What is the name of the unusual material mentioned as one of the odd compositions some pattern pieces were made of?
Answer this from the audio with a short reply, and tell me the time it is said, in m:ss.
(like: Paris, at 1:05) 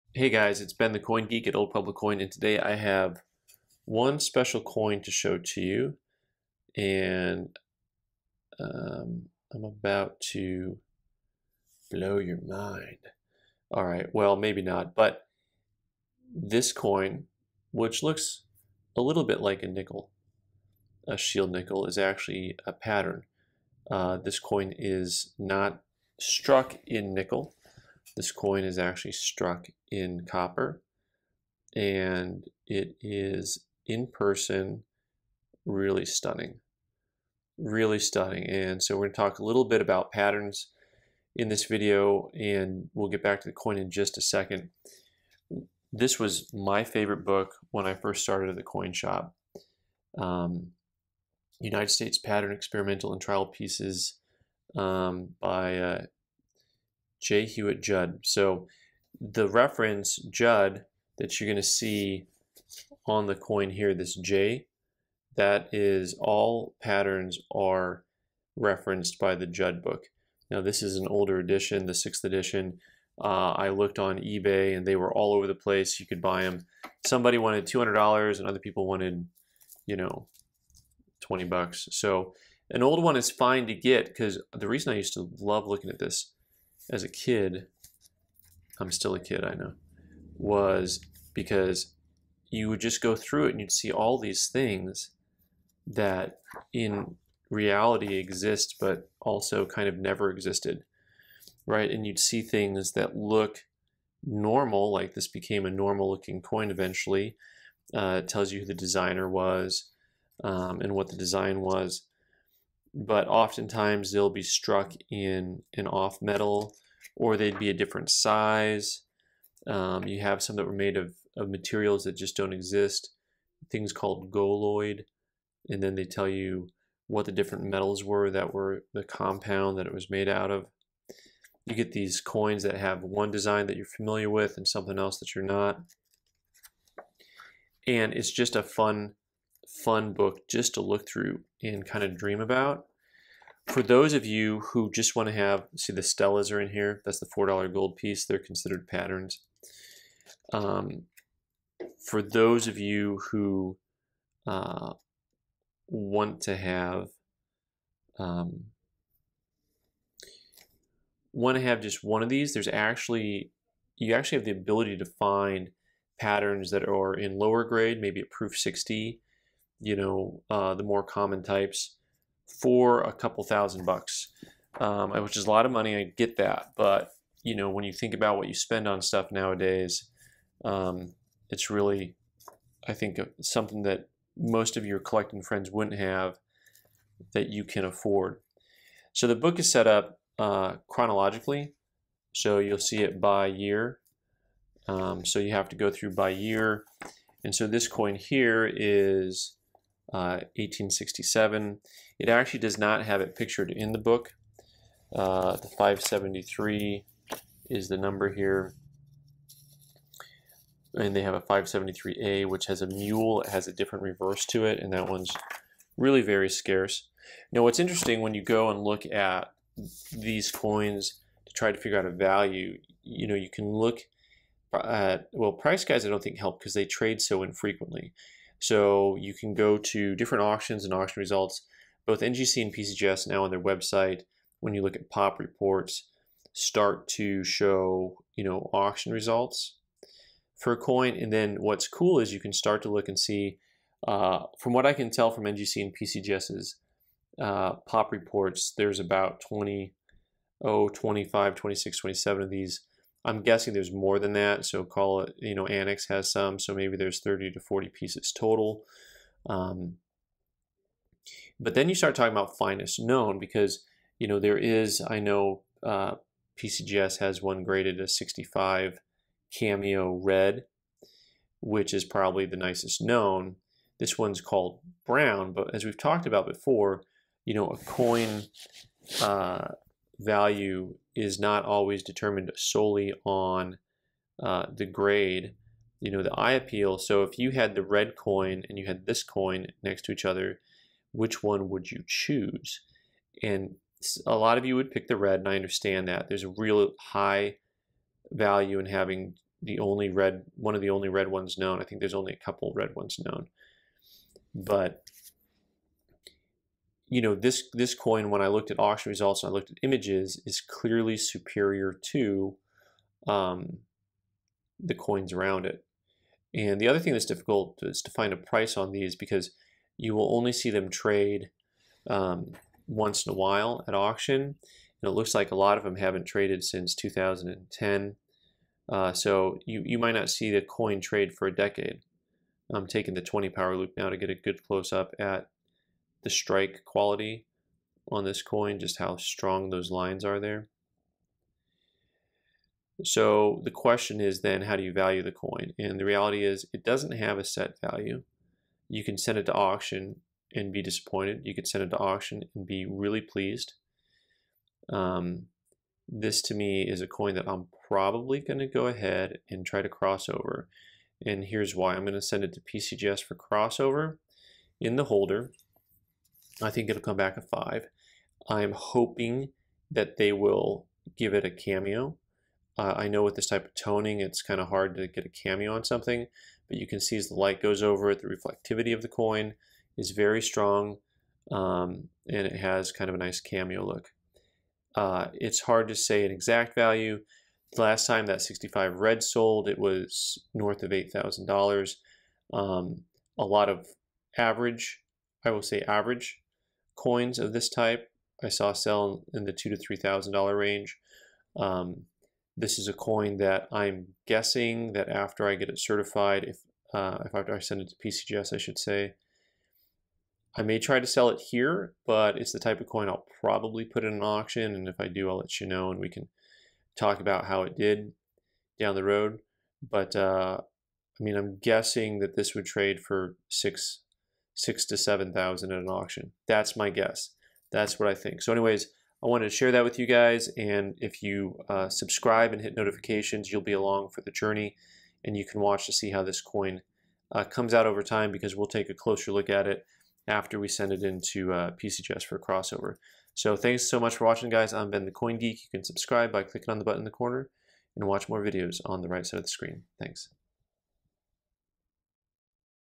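Goloid, at 2:04.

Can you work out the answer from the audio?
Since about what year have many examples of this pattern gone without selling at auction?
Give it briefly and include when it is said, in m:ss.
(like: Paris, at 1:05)
2010, at 5:26.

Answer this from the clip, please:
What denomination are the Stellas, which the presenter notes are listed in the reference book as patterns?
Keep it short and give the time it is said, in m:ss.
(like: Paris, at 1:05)
$4 gold piece, at 2:27.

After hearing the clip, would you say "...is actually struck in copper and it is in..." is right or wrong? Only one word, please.
right.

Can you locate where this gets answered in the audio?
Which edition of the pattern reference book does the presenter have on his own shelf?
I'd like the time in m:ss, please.
1:11.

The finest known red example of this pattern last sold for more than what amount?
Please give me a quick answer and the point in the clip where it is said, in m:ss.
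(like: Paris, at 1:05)
$8,000, at 6:30.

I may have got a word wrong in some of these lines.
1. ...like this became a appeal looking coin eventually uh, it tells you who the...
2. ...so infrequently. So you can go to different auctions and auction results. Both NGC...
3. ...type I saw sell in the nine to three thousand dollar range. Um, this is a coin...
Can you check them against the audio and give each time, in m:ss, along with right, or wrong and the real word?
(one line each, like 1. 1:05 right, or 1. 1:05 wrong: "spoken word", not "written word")
1. 1:44 wrong: "normal", not "appeal"
2. 3:47 right
3. 6:37 wrong: "two", not "nine".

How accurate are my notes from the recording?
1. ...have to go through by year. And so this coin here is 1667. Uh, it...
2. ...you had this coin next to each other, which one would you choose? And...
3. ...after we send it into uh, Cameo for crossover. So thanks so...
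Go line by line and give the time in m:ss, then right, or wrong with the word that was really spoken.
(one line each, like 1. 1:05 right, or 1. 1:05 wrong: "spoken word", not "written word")
1. 3:15 wrong: "1867", not "1667"
2. 4:48 right
3. 7:20 wrong: "PCGS", not "Cameo".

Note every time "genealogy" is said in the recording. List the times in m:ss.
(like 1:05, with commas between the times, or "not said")
not said.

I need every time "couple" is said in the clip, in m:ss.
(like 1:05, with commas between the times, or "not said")
2:53, 5:02.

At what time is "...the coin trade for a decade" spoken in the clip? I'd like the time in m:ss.
5:30.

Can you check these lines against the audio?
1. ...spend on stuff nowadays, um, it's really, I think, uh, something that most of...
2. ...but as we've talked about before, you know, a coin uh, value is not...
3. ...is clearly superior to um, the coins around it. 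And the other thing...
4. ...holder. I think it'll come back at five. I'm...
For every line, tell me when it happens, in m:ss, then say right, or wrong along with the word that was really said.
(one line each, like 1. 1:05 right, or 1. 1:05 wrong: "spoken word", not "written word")
1. 2:58 right
2. 4:35 right
3. 5:10 right
4. 6:05 right.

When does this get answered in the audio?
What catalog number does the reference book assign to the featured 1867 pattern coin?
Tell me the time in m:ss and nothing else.
3:25.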